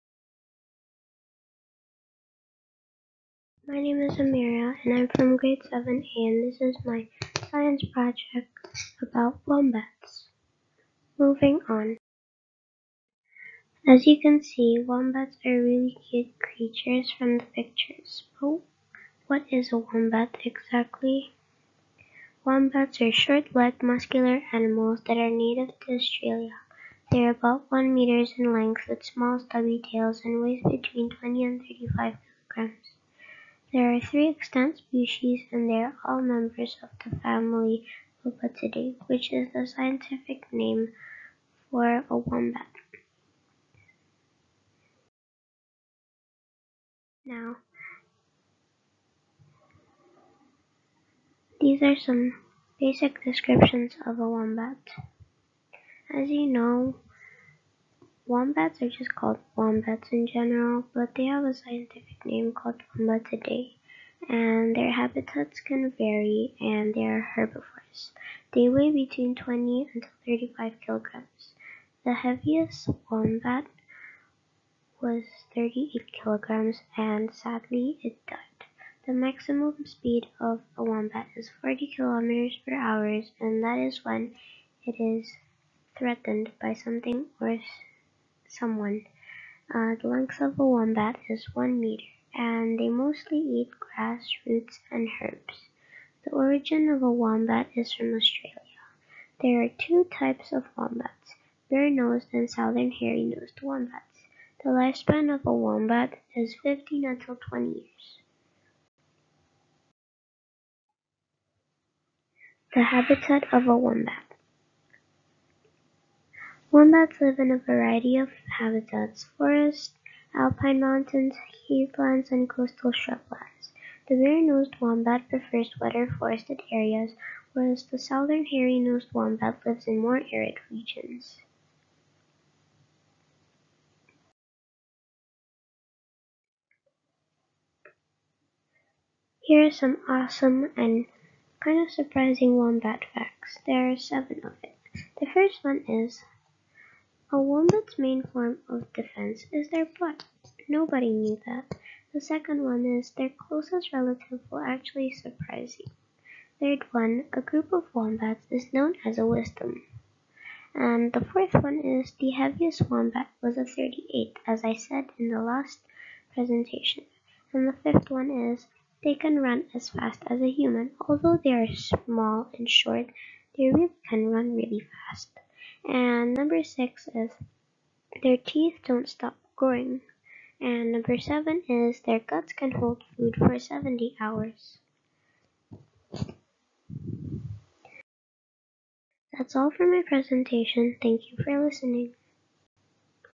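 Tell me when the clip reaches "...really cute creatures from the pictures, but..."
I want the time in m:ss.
0:15.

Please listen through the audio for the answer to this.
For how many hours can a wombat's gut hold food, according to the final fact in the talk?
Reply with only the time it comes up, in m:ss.
3:03.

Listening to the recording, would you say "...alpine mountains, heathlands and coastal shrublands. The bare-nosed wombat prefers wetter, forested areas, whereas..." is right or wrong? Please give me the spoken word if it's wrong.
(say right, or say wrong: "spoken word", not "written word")
right.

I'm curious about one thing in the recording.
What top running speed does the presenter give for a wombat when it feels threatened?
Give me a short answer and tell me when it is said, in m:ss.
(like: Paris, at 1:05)
40 kilometers per hour, at 1:21.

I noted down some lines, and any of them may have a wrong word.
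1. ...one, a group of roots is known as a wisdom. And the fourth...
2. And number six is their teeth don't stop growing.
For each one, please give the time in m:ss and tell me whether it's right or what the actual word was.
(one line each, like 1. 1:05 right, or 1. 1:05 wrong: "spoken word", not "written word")
1. 2:36 wrong: "wombats", not "roots"
2. 2:55 right.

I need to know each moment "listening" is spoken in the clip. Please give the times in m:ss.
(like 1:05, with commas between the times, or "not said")
3:11.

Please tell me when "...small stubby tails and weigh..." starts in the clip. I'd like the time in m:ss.
0:29.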